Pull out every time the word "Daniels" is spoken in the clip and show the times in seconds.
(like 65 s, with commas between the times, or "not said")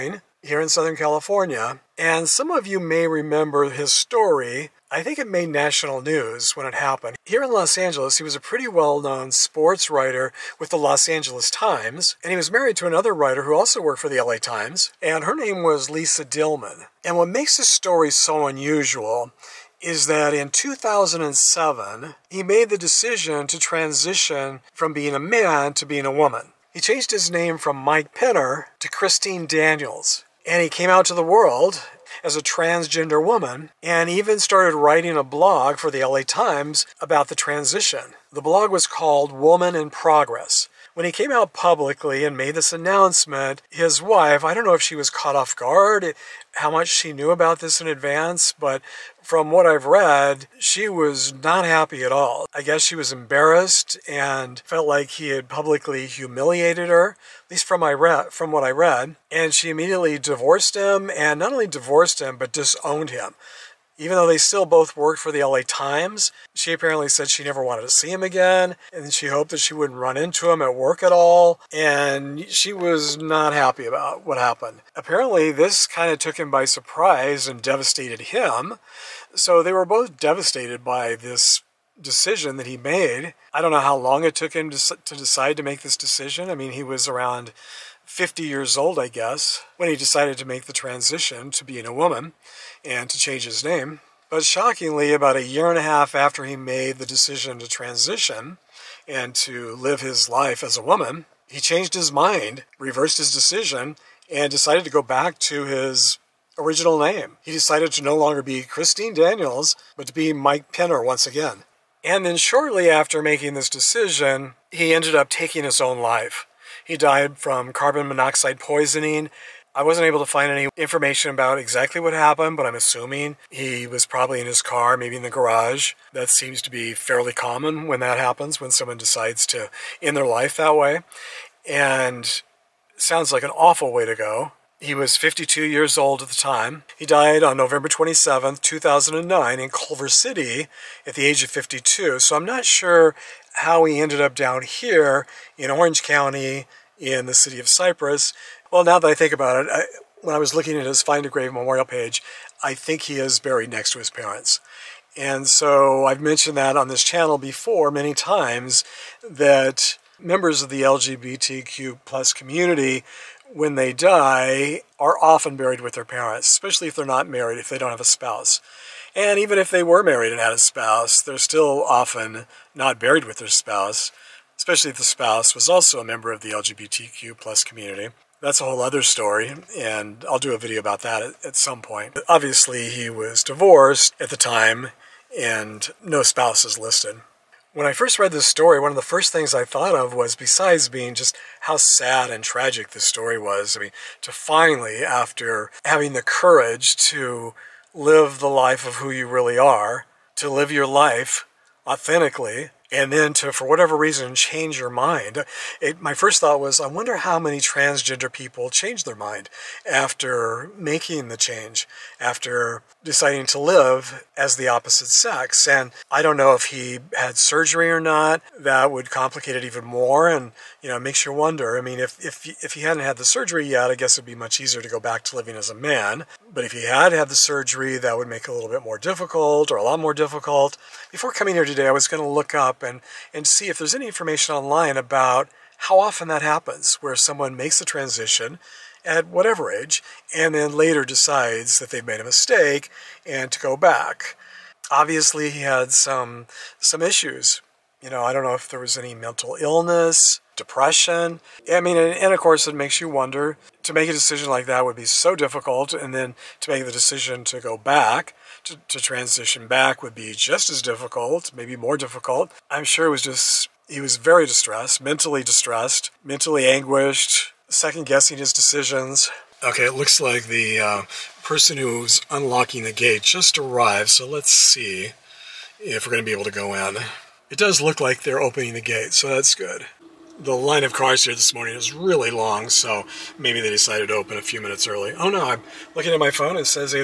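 29 s, 109 s.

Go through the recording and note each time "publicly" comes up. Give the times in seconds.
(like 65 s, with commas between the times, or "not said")
41 s, 55 s.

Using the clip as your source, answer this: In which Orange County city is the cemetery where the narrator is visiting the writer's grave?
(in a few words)
Cypress.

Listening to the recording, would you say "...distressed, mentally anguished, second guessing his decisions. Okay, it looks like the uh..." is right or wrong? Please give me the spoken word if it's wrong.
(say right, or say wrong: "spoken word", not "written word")
right.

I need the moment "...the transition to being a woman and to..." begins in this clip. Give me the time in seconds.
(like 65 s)
90 s.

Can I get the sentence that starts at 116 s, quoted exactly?
He died from carbon monoxide poisoning.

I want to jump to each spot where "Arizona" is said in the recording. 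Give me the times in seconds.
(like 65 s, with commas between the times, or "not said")
not said.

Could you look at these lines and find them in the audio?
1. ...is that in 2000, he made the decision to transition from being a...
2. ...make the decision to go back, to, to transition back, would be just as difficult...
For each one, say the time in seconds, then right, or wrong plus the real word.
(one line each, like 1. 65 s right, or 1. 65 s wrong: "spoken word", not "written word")
1. 19 s wrong: "2007", not "2000"
2. 256 s right.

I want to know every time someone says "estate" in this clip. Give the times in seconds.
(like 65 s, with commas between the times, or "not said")
not said.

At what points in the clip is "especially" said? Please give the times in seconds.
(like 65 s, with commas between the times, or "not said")
166 s, 174 s.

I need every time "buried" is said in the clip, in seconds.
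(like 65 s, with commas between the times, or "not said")
153 s, 165 s, 172 s.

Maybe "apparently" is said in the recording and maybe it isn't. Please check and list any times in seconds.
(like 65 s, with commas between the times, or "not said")
66 s, 74 s.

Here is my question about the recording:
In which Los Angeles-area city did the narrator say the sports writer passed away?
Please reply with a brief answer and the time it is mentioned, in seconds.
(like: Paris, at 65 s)
Culver City, at 139 s.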